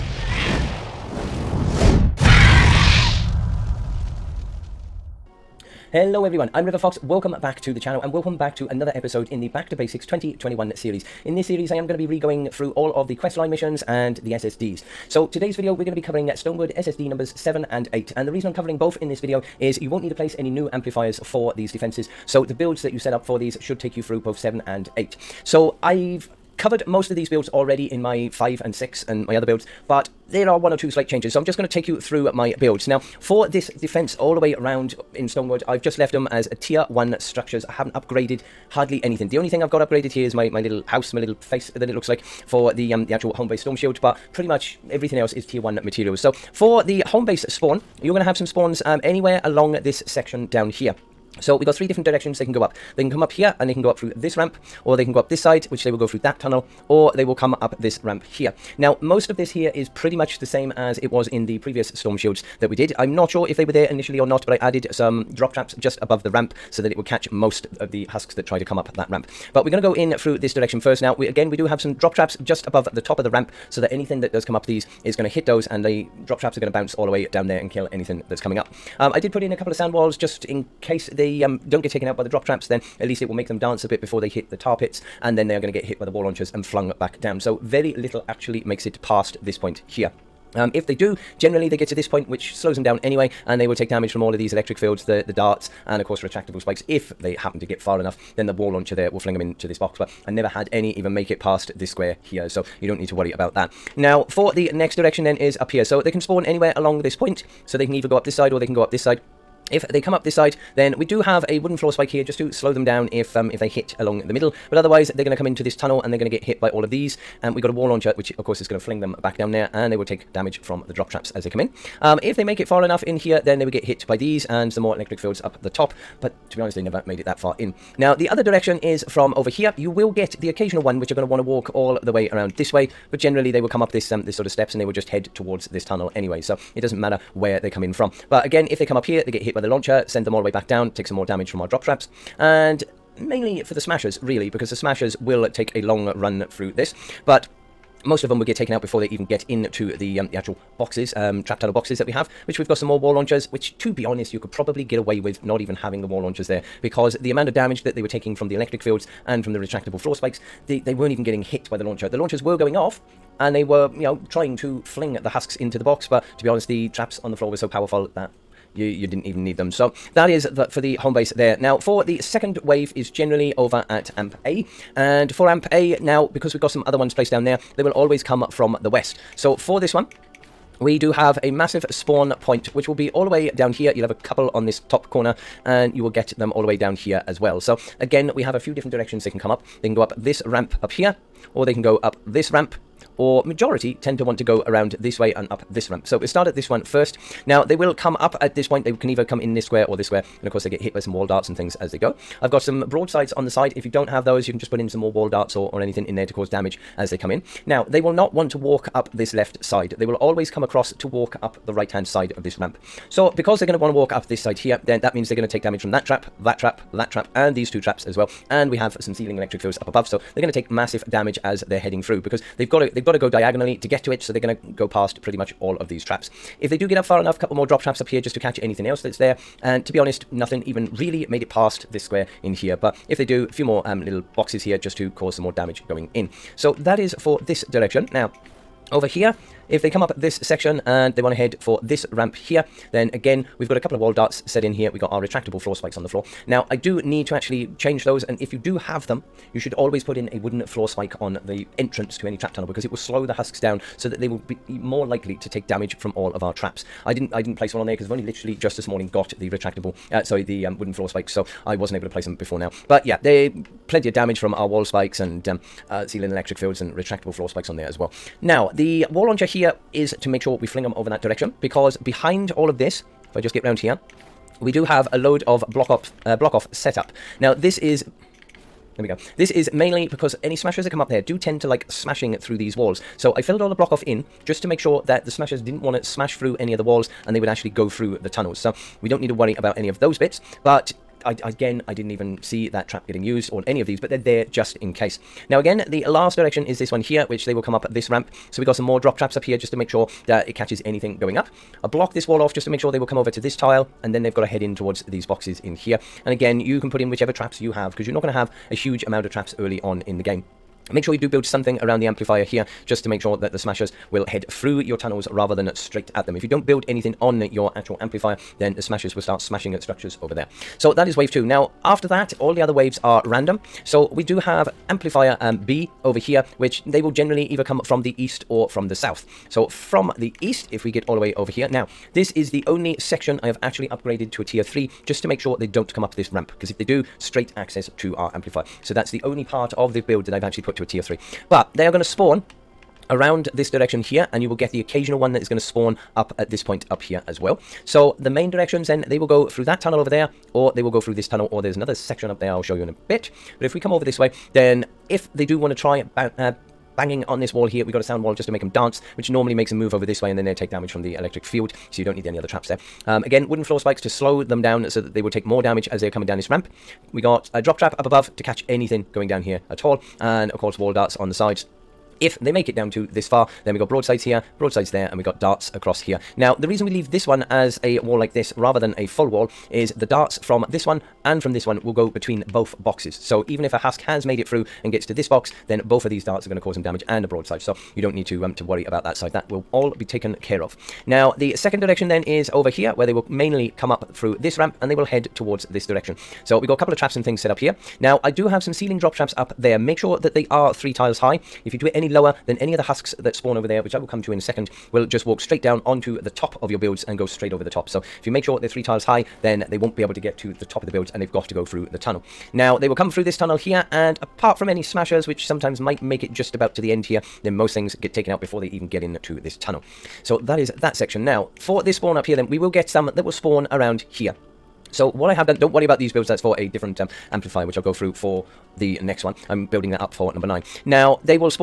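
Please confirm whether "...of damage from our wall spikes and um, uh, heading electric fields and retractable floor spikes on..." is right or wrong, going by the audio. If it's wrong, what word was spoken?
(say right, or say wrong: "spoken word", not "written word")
wrong: "ceiling", not "heading".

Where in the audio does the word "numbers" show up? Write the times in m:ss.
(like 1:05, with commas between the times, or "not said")
0:17, 7:10.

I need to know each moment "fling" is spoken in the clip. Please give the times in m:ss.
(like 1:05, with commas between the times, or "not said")
1:39, 1:58, 2:44, 4:30.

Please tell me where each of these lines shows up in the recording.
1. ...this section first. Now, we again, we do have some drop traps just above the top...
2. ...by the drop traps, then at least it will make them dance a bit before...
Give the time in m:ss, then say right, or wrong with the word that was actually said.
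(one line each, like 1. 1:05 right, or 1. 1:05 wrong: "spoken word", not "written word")
1. 1:10 wrong: "direction", not "section"
2. 1:22 right.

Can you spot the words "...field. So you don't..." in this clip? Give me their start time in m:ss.
6:01.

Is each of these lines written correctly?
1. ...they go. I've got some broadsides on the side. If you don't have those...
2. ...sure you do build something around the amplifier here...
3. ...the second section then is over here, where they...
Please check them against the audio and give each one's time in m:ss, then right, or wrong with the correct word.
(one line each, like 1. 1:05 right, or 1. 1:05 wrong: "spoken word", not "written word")
1. 3:21 right
2. 5:11 right
3. 6:31 wrong: "direction", not "section".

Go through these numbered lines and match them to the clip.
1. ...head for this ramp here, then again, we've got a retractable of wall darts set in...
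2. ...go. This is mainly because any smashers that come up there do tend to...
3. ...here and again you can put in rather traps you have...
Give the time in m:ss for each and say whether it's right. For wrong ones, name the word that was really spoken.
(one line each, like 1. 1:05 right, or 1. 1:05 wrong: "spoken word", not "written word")
1. 4:01 wrong: "couple", not "retractable"
2. 4:39 right
3. 5:05 wrong: "whichever", not "rather".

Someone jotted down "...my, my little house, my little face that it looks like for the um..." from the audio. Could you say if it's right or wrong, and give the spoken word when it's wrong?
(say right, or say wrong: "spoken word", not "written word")
right.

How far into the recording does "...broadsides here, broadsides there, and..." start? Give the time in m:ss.
6:13.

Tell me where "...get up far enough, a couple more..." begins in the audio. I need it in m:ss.
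3:46.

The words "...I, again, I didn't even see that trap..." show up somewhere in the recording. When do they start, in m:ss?
4:51.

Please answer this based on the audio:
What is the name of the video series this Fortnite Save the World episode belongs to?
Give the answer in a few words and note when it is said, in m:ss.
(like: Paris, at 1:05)
Back to Basics 2021, at 0:09.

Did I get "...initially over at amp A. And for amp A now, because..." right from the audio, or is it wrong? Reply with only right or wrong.
wrong.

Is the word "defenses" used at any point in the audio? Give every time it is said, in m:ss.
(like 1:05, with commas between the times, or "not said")
0:21, 0:33.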